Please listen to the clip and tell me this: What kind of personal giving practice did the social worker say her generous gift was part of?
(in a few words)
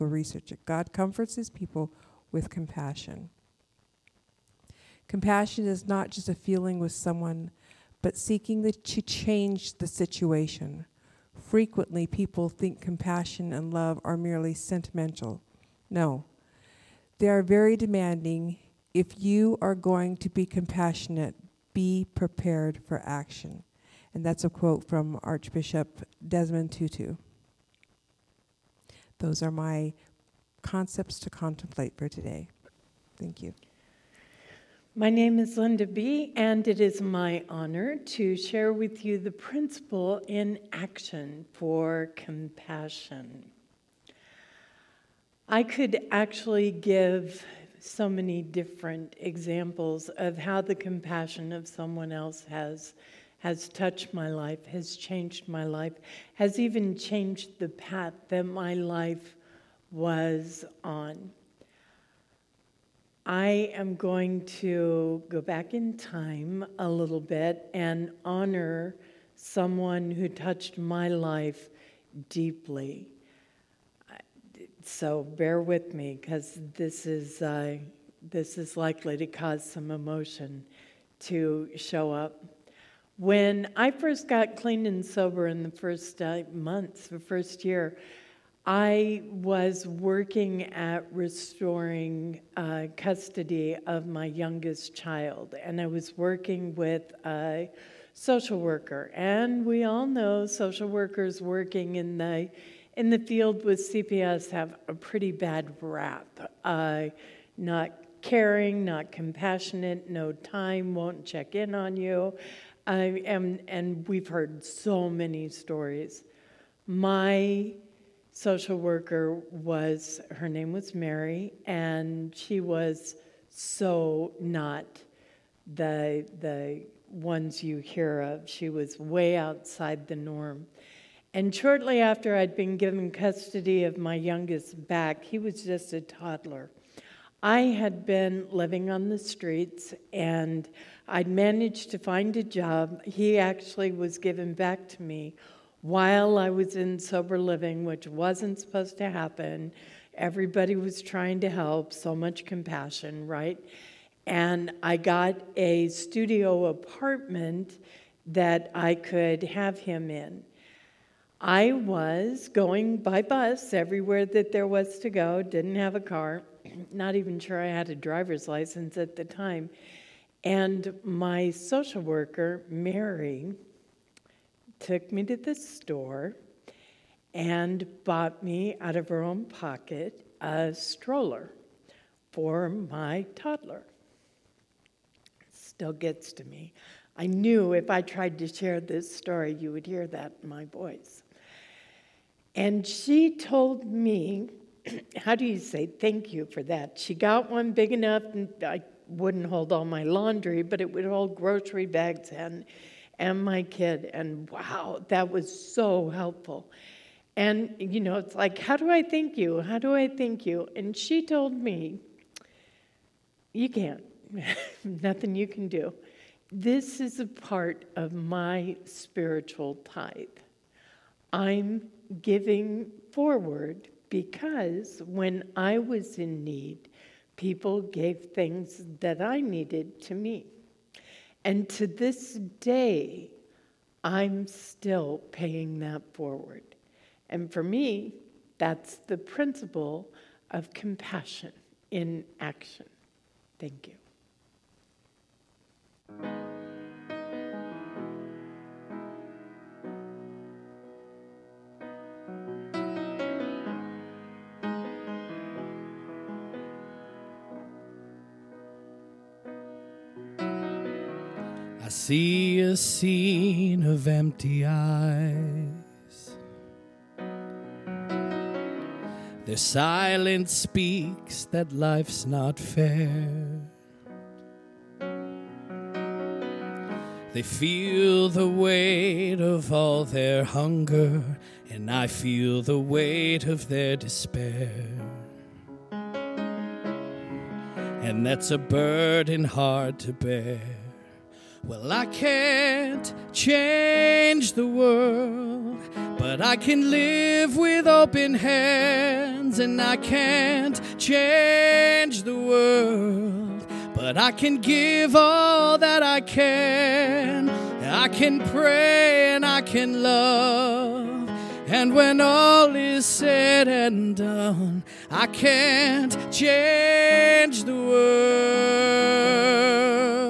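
spiritual tithe.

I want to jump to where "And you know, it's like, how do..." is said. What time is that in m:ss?
3:27.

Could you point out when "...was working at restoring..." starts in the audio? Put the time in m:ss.
1:29.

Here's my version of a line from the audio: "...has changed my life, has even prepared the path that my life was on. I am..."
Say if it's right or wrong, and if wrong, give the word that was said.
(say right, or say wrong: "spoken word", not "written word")
wrong: "changed", not "prepared".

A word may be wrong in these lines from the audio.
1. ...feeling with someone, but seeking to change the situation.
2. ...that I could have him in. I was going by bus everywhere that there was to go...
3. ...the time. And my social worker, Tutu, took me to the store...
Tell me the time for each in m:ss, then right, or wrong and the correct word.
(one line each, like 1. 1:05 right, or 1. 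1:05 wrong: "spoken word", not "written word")
1. 0:06 right
2. 2:38 right
3. 2:49 wrong: "Mary", not "Tutu".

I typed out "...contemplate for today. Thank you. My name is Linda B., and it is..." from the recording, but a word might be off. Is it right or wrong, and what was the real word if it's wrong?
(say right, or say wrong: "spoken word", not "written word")
right.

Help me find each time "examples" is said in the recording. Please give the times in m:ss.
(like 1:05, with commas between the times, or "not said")
0:49.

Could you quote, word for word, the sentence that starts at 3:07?
I knew if I tried to share this story, you would hear that in my voice.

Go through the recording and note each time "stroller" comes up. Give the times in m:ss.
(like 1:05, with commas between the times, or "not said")
3:00.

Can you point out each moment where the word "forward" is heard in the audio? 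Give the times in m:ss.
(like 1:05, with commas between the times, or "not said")
3:43, 3:56.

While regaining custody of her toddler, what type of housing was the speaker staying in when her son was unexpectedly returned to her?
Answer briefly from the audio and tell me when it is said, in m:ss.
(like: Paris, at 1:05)
sober living, at 2:27.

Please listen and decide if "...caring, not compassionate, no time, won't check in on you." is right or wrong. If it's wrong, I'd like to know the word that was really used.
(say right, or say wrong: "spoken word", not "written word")
right.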